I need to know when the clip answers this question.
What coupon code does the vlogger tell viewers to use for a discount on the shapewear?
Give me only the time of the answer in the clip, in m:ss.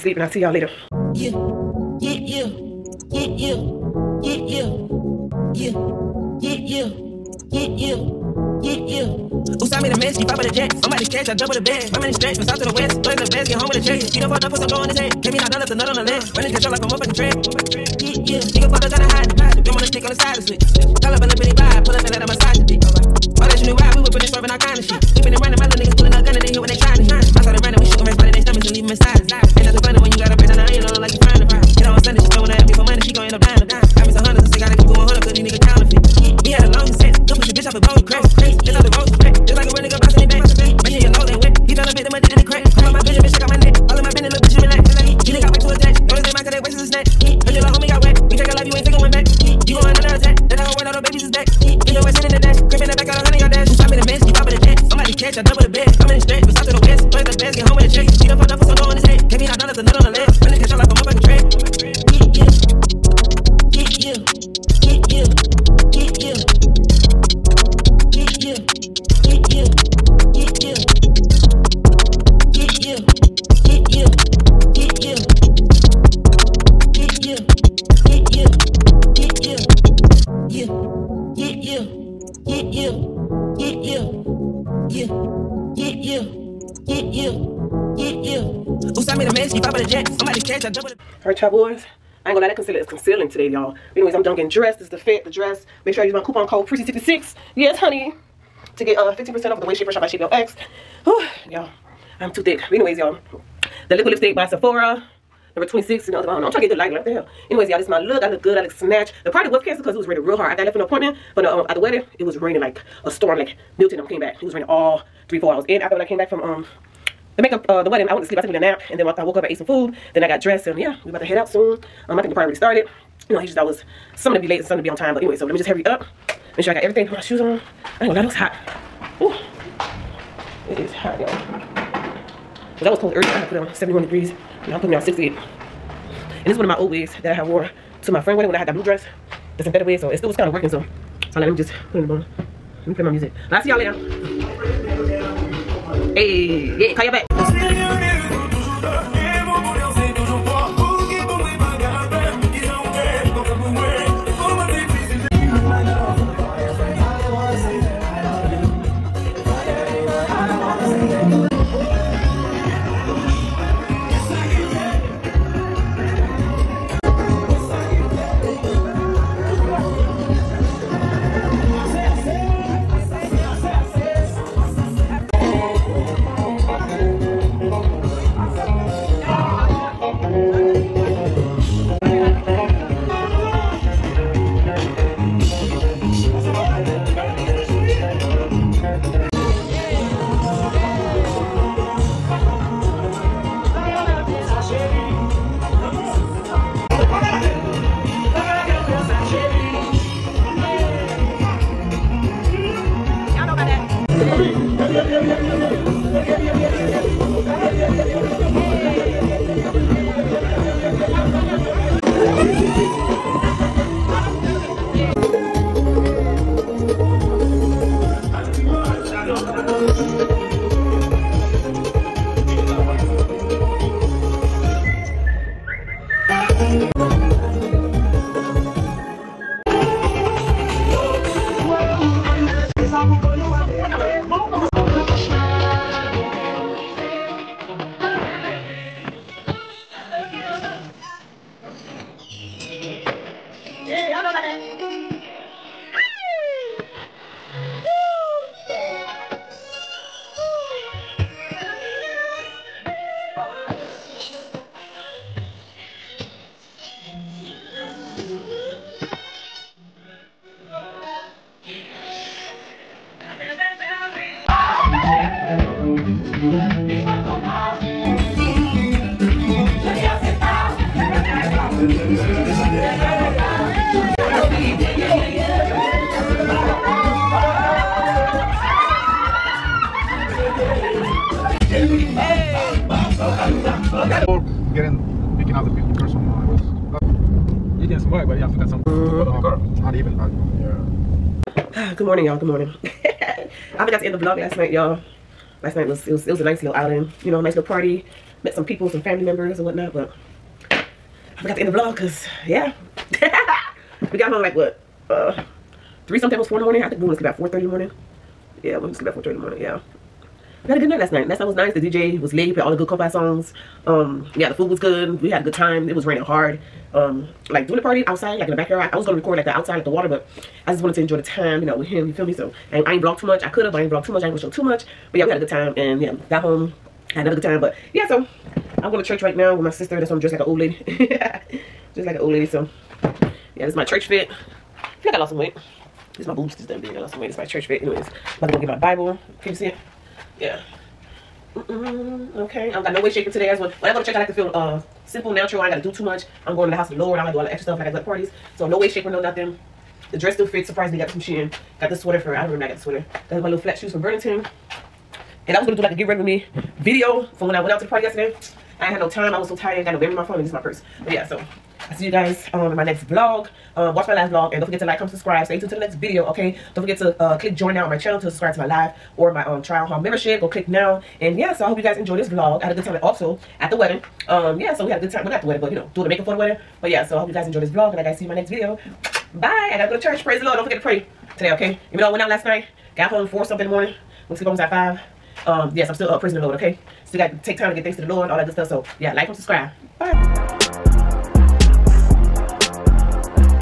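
1:36.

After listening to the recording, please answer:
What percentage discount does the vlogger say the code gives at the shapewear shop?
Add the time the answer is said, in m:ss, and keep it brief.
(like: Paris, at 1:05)
15%, at 1:39.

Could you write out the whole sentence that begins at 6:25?
Um, yes, I'm still up praising the Lord, okay?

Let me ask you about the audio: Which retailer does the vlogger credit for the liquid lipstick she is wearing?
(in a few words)
Sephora.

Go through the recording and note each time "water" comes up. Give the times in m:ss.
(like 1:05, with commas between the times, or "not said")
5:19.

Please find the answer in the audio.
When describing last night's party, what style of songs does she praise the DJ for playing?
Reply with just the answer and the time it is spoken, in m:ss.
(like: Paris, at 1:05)
Kompa, at 5:12.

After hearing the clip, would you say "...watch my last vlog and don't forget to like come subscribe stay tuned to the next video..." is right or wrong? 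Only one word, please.
right.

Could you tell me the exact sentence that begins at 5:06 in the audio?
I think we went to sleep about four thirty in the morning.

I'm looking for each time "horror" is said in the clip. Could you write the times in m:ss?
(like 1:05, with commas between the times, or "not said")
not said.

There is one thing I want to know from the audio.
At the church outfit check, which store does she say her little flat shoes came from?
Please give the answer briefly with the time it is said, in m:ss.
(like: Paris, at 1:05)
Burlington, at 5:54.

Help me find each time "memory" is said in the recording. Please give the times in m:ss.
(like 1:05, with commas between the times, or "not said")
5:59.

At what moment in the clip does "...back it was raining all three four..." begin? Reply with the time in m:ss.
1:54.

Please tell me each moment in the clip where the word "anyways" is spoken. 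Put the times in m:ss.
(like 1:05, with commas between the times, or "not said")
1:33, 1:42, 1:47, 2:05, 5:37.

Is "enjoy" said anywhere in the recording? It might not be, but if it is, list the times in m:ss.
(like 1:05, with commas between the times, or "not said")
5:21, 6:11, 6:17.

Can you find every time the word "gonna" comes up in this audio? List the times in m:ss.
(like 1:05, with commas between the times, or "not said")
1:32, 2:08, 5:19, 5:24.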